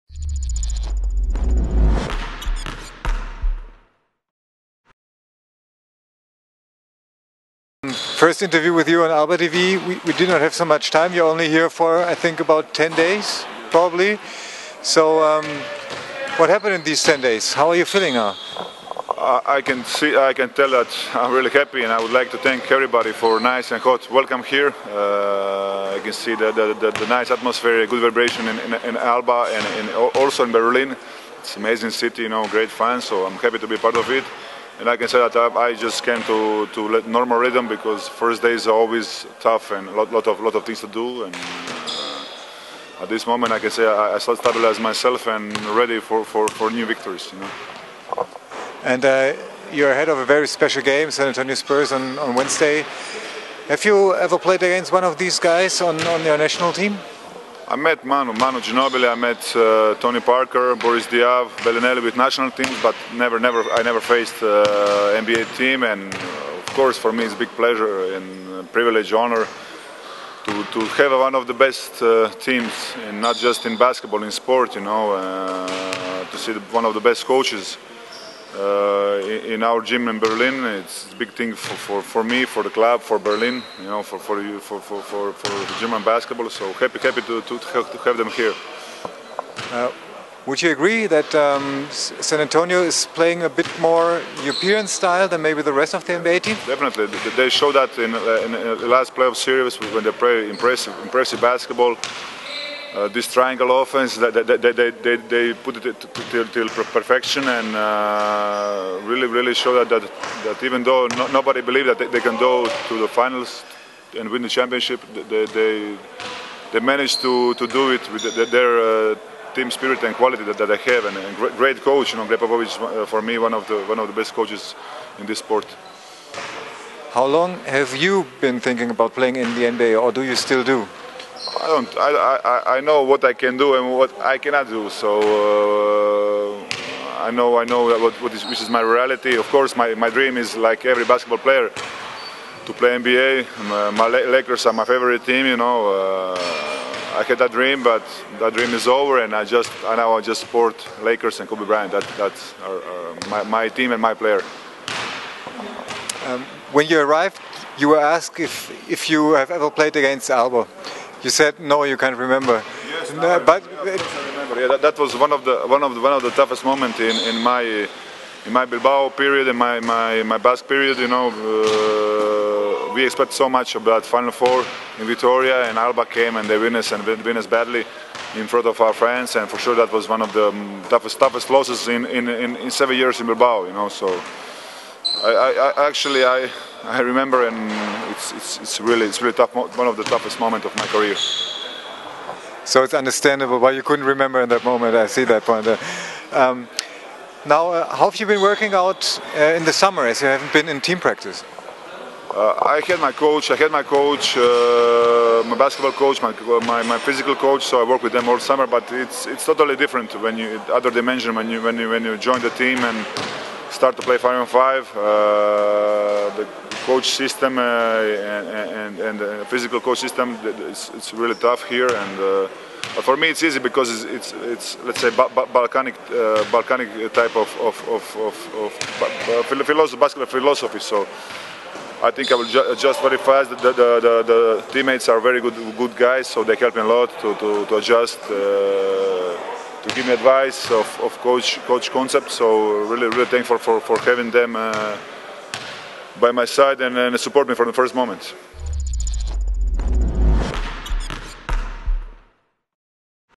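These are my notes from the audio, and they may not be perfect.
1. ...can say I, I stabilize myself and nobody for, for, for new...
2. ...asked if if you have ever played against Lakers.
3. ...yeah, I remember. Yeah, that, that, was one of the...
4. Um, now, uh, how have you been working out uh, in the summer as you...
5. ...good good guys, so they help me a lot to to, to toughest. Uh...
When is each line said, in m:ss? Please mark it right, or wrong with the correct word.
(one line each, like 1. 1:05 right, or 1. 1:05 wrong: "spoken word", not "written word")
1. 0:43 wrong: "ready", not "nobody"
2. 2:37 wrong: "Alba", not "Lakers"
3. 2:43 right
4. 3:16 right
5. 3:55 wrong: "adjust", not "toughest".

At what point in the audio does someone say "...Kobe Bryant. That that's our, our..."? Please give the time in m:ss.
2:31.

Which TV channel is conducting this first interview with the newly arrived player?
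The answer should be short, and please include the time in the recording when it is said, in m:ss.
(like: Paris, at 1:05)
Alba TV, at 0:09.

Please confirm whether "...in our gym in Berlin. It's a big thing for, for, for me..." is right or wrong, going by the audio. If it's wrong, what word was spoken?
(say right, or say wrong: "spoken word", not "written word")
right.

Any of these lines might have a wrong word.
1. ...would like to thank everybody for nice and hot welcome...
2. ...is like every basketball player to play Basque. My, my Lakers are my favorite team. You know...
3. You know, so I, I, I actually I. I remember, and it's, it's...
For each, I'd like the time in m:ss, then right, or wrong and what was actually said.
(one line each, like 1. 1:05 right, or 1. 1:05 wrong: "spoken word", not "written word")
1. 0:21 right
2. 2:20 wrong: "NBA", not "Basque"
3. 3:03 right.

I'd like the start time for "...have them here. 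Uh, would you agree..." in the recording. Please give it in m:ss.
1:28.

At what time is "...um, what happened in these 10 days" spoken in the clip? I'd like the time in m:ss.
0:15.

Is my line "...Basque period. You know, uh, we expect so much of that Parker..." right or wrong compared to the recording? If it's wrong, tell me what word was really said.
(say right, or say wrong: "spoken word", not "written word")
wrong: "Final", not "Parker".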